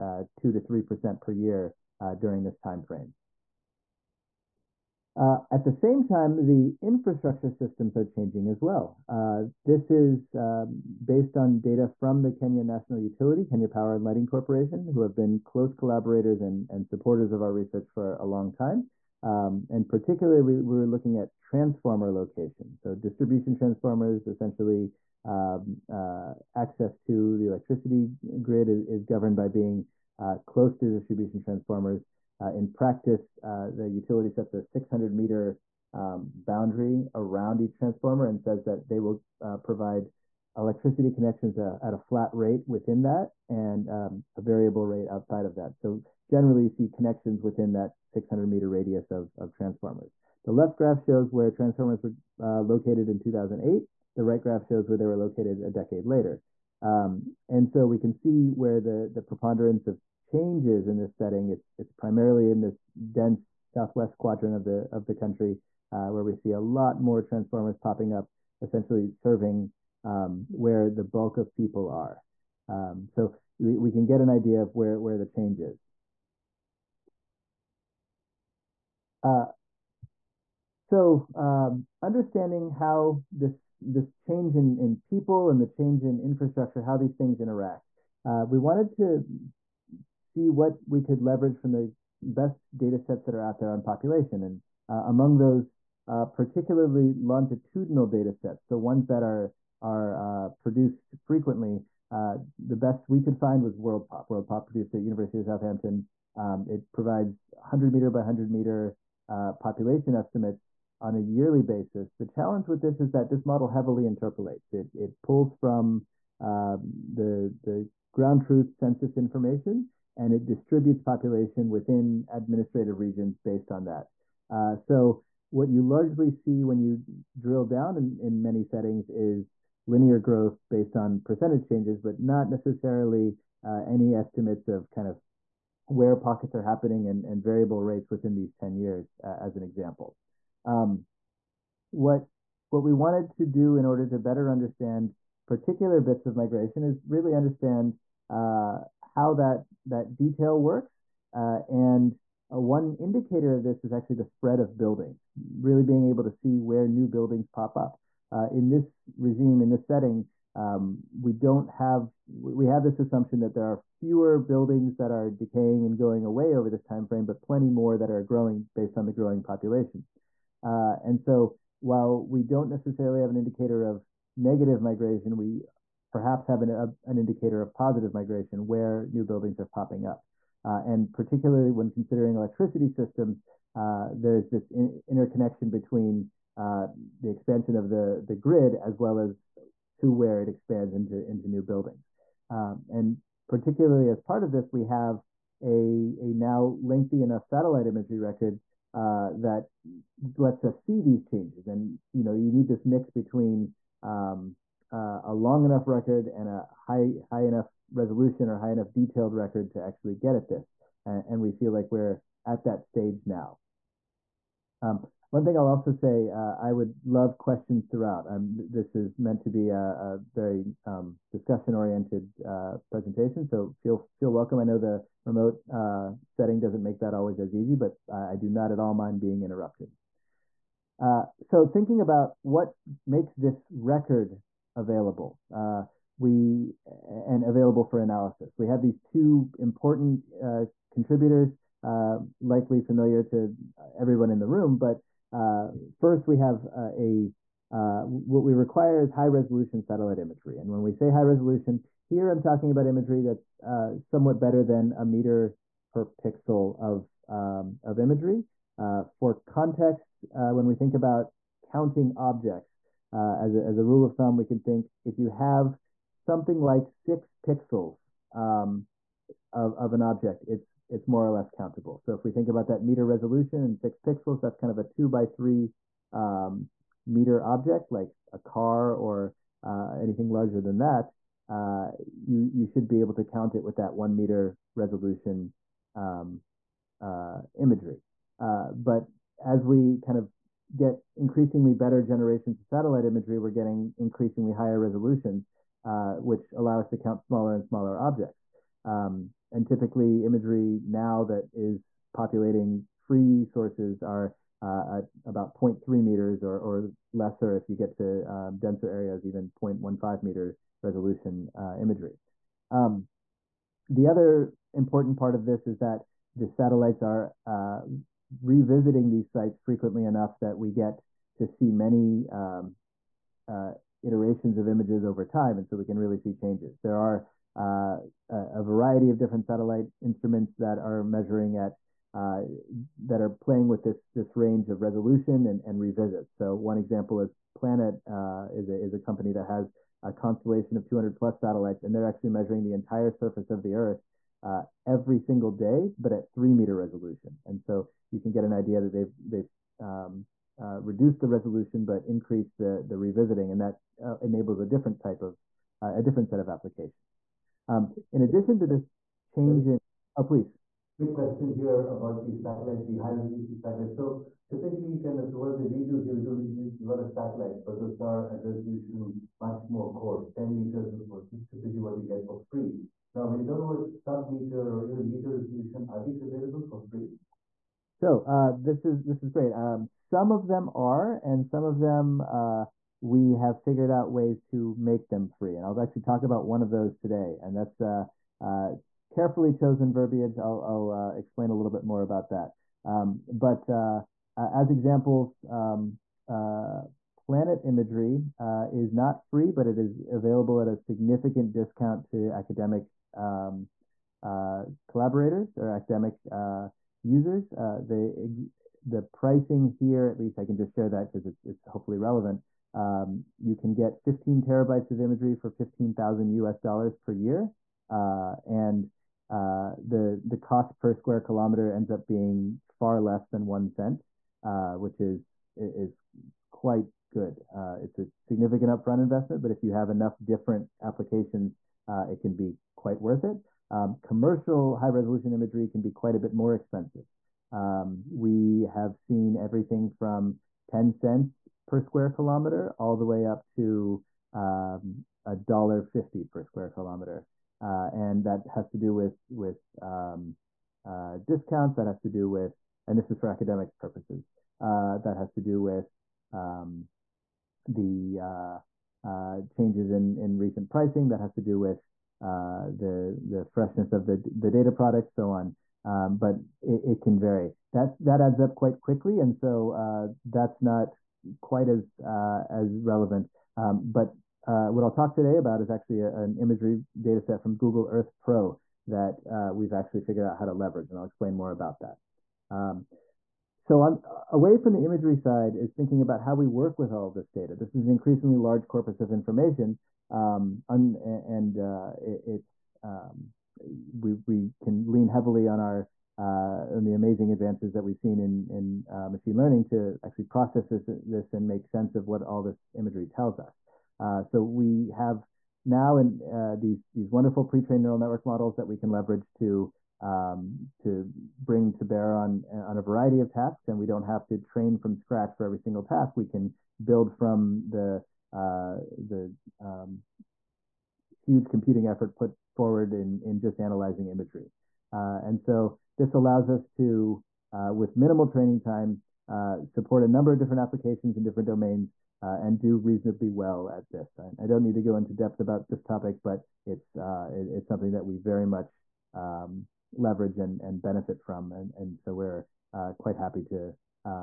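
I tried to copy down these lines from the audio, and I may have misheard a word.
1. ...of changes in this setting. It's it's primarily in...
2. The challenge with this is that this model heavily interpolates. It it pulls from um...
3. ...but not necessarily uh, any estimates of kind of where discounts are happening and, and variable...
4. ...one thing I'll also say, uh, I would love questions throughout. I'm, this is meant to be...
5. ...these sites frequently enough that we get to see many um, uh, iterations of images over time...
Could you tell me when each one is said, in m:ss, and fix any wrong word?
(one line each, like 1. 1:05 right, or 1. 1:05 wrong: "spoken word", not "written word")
1. 0:59 right
2. 1:52 right
3. 2:11 wrong: "pockets", not "discounts"
4. 3:35 right
5. 5:19 right.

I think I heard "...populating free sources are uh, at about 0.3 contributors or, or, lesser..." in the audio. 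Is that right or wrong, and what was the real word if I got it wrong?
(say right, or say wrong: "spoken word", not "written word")
wrong: "meters", not "contributors".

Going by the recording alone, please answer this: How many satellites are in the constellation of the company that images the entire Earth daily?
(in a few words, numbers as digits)
200 plus.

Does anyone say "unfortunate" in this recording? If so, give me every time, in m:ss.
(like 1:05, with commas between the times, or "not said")
not said.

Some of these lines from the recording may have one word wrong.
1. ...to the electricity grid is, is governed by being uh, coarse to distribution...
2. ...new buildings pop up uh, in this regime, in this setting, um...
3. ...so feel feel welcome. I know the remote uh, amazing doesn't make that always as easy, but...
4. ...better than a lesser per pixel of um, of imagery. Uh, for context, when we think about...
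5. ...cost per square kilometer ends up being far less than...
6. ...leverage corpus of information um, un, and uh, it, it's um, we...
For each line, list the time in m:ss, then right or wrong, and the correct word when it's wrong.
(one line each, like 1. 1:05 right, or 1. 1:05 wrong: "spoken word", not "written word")
1. 0:26 wrong: "close", not "coarse"
2. 2:36 right
3. 3:43 wrong: "setting", not "amazing"
4. 4:14 wrong: "meter", not "lesser"
5. 7:00 right
6. 8:08 wrong: "large", not "leverage".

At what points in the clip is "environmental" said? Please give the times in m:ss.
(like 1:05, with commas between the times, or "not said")
not said.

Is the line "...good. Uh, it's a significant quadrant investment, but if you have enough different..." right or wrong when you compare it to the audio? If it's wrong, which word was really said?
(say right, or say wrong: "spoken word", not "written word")
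wrong: "upfront", not "quadrant".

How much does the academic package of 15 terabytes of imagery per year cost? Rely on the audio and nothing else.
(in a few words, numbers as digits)
15,000 US dollars.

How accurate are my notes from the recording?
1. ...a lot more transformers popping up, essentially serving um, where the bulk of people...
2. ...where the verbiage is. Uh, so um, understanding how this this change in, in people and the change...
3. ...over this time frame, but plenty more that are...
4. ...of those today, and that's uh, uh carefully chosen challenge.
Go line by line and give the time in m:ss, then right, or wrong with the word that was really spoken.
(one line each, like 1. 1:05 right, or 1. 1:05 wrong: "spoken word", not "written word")
1. 1:06 right
2. 1:14 wrong: "change", not "verbiage"
3. 2:46 right
4. 6:26 wrong: "verbiage", not "challenge".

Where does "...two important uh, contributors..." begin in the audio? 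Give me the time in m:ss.
3:58.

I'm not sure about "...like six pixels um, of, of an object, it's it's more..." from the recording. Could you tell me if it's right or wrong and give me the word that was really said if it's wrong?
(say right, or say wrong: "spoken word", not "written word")
right.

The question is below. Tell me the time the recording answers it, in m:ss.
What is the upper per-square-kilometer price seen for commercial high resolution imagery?
7:25.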